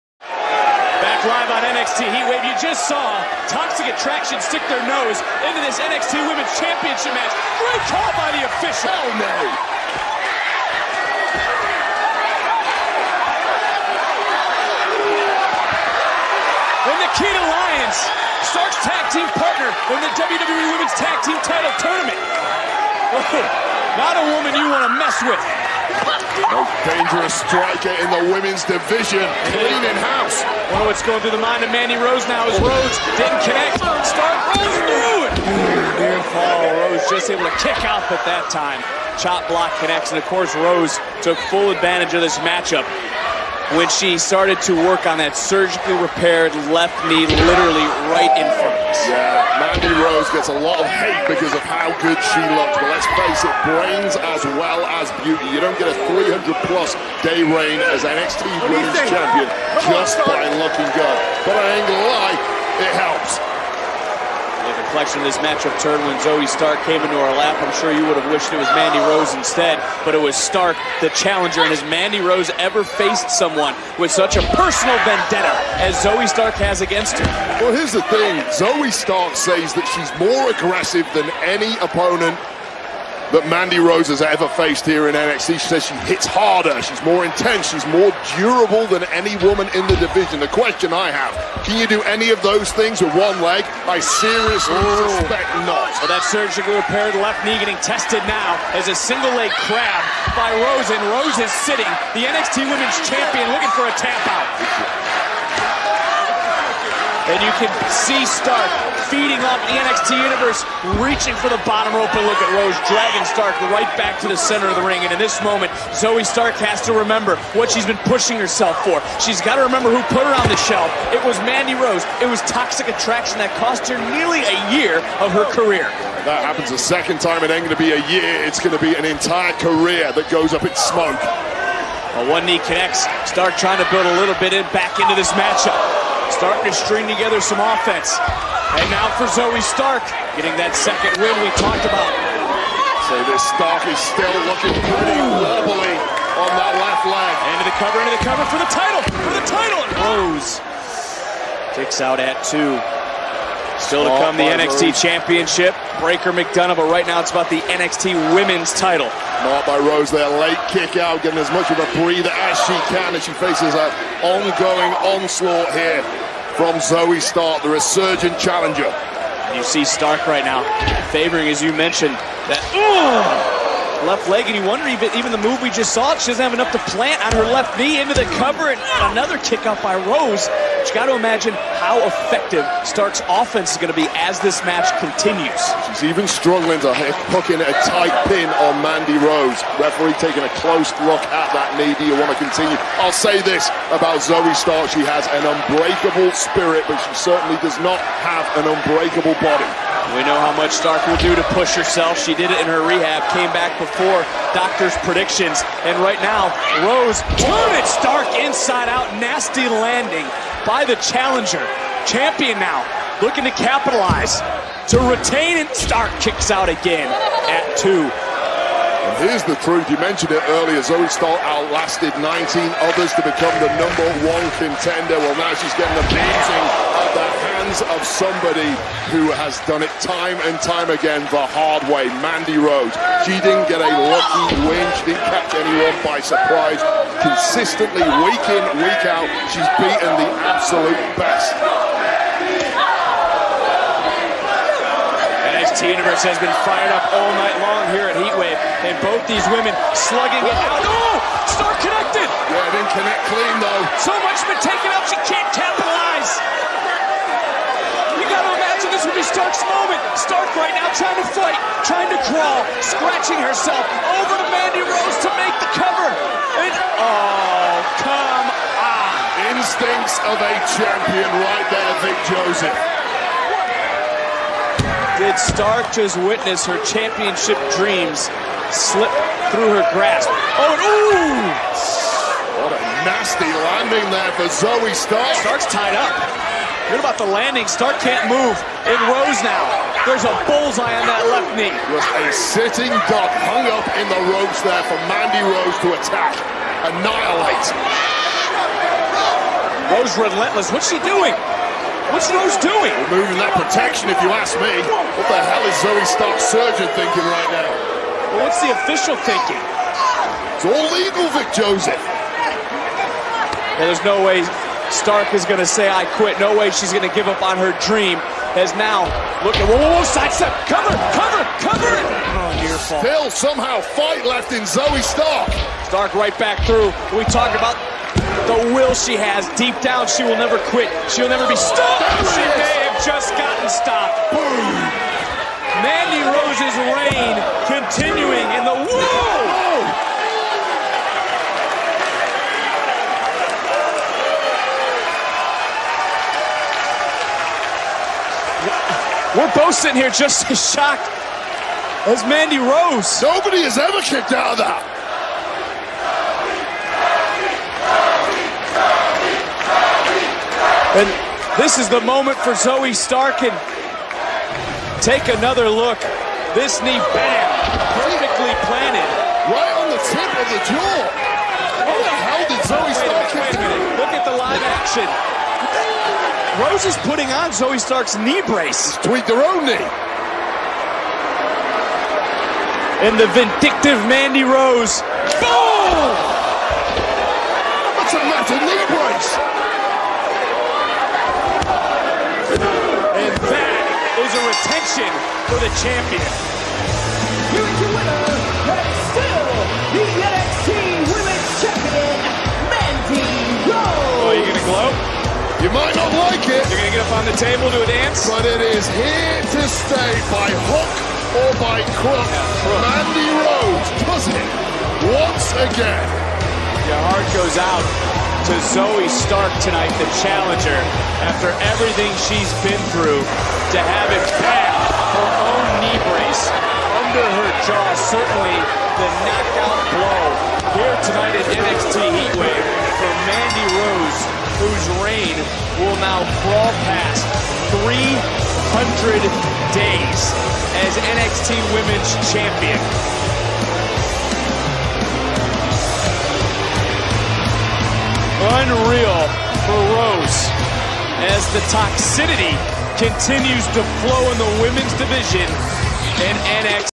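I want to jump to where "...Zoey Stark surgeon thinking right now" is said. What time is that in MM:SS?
05:05.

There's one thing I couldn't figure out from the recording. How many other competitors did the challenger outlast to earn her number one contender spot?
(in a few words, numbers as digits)
19.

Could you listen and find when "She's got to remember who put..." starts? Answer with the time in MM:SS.
01:59.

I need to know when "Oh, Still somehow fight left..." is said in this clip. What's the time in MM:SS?
05:22.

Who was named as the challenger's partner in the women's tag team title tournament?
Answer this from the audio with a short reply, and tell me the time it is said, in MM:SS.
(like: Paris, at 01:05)
Nikita Lyons, at 00:17.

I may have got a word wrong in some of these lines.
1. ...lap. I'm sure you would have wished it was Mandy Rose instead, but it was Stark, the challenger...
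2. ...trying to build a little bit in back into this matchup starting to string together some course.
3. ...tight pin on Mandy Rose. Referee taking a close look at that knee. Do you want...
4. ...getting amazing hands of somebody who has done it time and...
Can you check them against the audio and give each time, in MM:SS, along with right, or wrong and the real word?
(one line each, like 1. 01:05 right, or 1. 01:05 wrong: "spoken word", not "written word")
1. 01:07 right
2. 02:13 wrong: "offense", not "course"
3. 03:07 right
4. 03:45 right.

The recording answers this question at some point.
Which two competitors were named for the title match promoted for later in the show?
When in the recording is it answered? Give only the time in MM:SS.
02:35.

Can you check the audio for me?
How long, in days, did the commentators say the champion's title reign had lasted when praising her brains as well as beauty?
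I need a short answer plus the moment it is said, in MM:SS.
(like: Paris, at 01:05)
300-plus, at 00:56.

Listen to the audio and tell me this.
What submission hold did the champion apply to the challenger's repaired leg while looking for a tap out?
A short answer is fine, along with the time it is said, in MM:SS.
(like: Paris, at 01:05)
single leg crab, at 01:38.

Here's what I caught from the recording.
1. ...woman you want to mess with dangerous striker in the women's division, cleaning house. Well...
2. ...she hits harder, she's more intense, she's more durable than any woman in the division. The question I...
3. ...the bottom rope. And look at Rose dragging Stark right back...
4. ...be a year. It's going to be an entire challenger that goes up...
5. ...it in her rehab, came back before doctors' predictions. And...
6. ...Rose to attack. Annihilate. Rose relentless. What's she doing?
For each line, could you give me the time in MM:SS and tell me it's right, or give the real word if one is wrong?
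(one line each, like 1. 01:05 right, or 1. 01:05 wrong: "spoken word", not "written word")
1. 00:24 right
2. 01:25 right
3. 01:51 right
4. 02:07 wrong: "career", not "challenger"
5. 03:22 right
6. 04:55 right.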